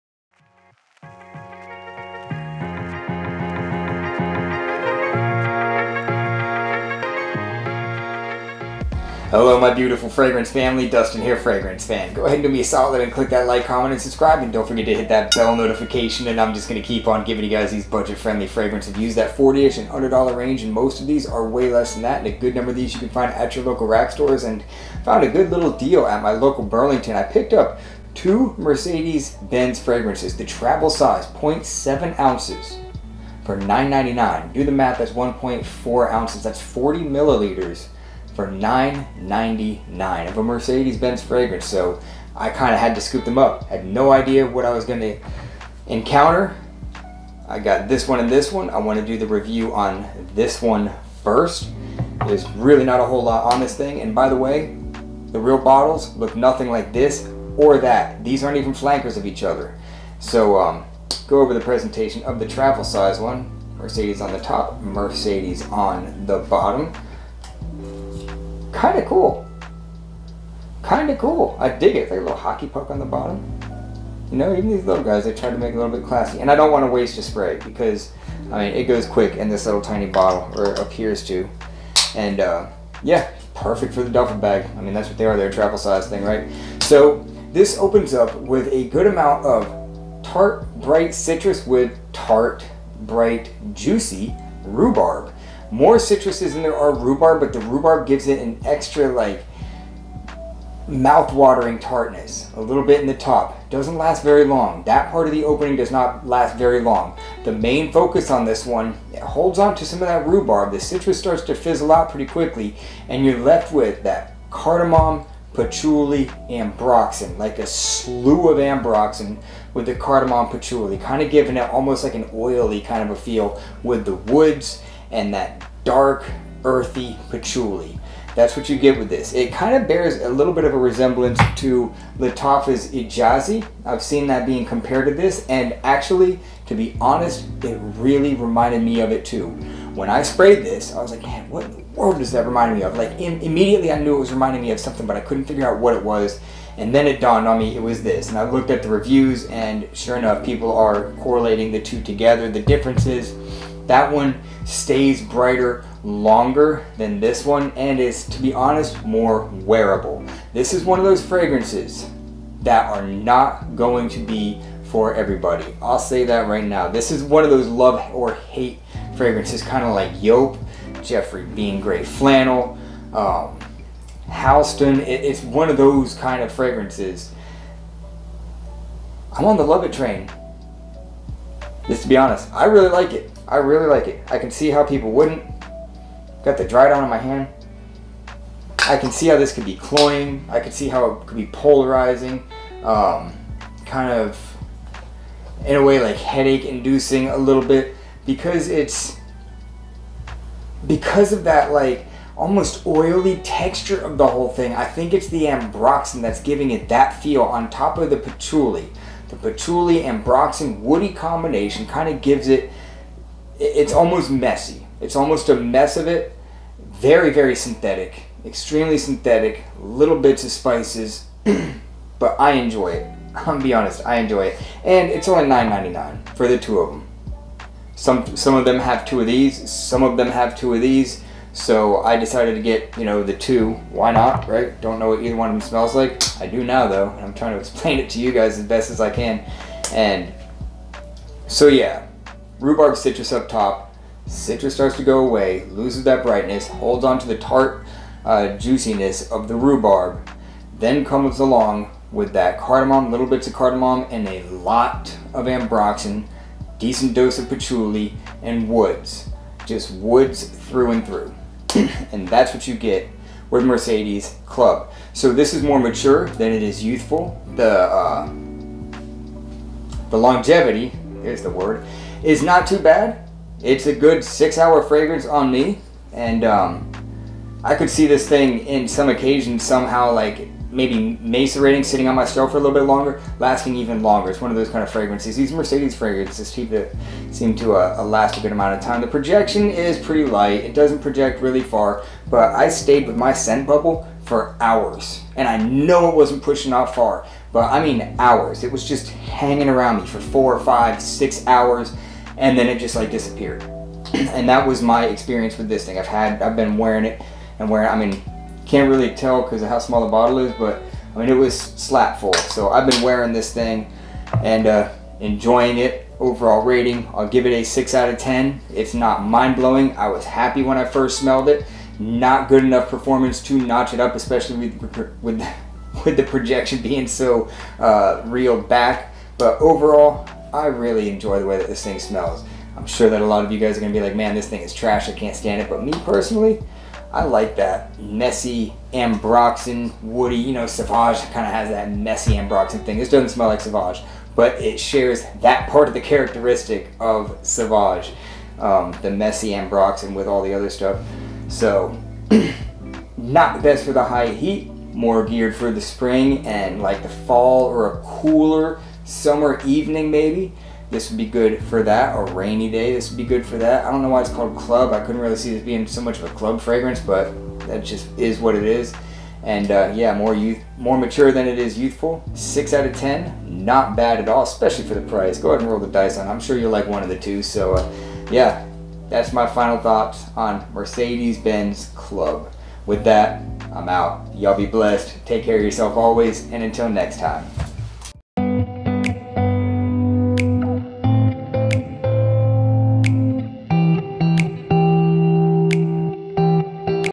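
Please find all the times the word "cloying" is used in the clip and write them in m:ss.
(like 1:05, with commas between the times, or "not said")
3:09.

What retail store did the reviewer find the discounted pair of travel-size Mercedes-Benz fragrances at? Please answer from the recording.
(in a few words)
Burlington.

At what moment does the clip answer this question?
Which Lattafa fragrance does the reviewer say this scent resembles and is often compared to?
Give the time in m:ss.
2:12.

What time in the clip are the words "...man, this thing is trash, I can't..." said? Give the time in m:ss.
5:34.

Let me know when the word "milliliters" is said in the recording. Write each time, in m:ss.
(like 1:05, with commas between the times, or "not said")
0:37.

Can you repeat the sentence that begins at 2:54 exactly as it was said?
It, it's one of those kind of fragrances.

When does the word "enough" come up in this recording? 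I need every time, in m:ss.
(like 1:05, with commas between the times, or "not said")
2:30, 5:22.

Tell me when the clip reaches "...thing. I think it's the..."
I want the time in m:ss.
3:24.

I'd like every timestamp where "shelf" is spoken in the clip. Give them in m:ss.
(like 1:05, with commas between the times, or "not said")
4:42.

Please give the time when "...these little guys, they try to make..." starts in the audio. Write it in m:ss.
1:14.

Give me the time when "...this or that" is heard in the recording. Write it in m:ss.
0:56.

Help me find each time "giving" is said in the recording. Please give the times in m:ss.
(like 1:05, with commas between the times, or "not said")
0:17, 2:01, 3:26.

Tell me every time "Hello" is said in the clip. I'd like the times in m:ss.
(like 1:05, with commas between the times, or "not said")
0:09.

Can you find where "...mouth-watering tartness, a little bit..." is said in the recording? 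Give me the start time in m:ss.
1:40.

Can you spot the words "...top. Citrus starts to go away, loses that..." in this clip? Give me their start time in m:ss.
4:03.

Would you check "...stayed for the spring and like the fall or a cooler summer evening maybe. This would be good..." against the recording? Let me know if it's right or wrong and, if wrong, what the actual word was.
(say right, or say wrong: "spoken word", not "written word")
wrong: "geared", not "stayed".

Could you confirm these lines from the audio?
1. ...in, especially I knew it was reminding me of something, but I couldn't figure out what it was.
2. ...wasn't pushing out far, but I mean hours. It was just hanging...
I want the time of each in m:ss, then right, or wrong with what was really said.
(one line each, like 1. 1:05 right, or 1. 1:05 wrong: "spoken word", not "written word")
1. 2:23 wrong: "immediately", not "especially"
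2. 4:56 right.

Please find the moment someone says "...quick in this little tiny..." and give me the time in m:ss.
1:19.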